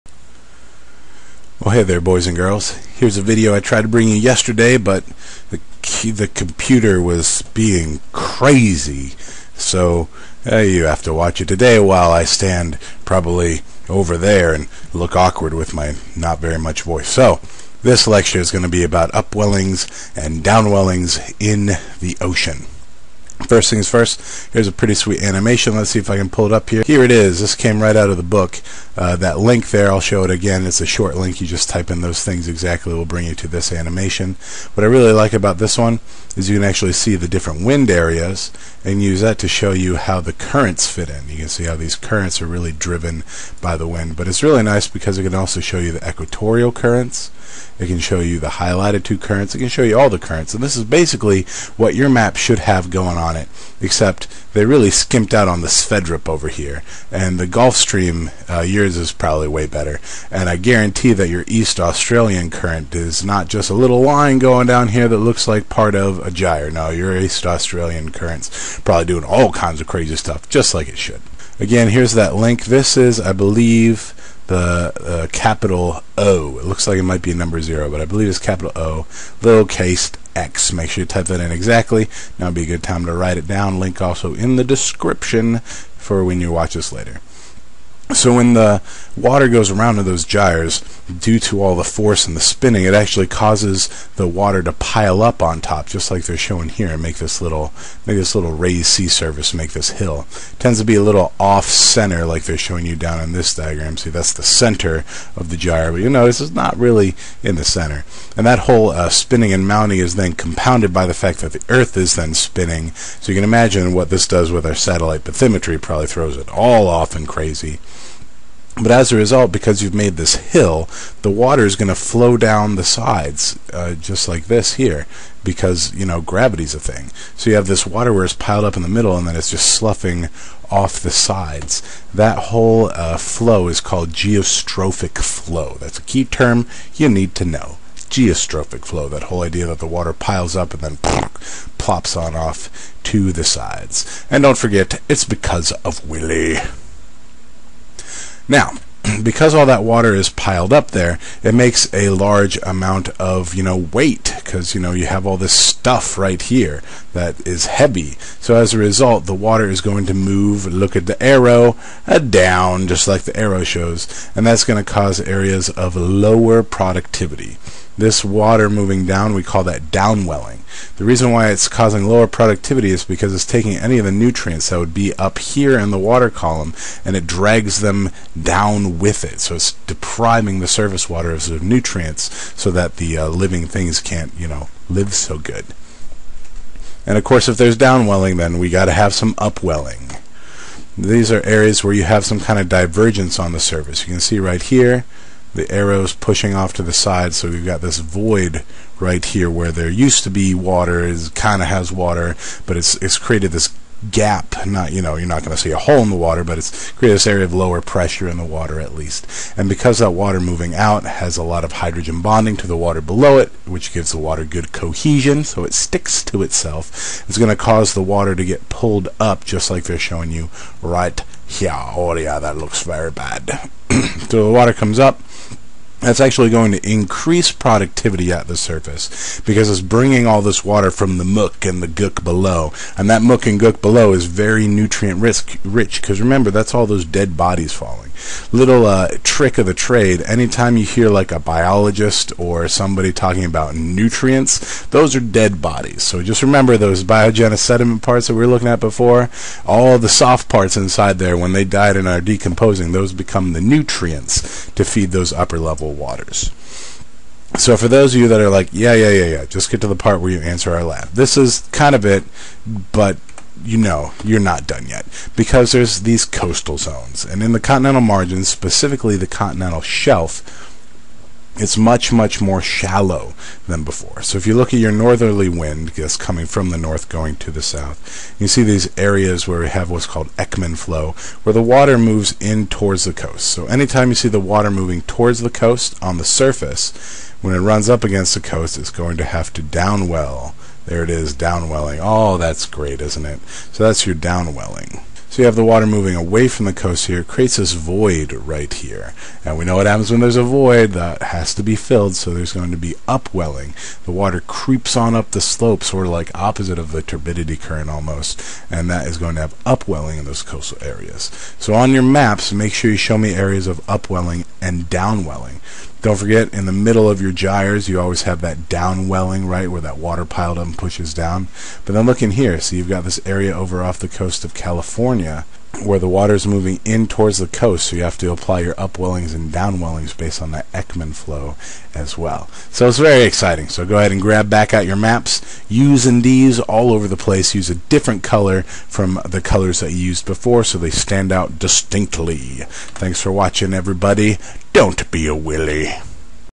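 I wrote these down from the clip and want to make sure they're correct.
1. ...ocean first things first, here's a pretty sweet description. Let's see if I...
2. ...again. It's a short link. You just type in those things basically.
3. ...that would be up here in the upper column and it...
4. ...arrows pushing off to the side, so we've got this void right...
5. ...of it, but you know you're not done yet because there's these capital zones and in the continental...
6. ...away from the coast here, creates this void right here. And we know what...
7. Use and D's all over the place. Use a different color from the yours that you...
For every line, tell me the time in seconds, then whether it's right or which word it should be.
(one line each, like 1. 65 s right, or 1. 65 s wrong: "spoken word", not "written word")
1. 22 s wrong: "animation", not "description"
2. 30 s wrong: "exactly", not "basically"
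3. 174 s wrong: "water", not "upper"
4. 195 s right
5. 261 s wrong: "coastal", not "capital"
6. 296 s right
7. 335 s wrong: "colors", not "yours".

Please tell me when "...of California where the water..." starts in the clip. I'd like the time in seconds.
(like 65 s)
324 s.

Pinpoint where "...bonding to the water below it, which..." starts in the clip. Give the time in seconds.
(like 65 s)
212 s.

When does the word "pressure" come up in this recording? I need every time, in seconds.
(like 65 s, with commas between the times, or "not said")
207 s.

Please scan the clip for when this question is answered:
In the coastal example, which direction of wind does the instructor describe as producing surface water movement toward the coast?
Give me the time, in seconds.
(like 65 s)
274 s.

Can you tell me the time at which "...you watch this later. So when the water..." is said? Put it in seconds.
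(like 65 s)
86 s.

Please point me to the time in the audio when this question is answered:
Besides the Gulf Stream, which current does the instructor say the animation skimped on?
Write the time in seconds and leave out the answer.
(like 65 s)
55 s.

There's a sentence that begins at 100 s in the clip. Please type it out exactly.
It tends to be a little off center, like they're showing you down in this diagram.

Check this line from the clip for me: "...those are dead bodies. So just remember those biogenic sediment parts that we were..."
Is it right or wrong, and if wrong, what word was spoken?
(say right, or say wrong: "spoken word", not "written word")
right.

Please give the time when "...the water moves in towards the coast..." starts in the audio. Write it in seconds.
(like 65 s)
281 s.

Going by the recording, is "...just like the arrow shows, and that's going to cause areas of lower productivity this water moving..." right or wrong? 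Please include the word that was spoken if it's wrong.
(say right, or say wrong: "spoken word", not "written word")
right.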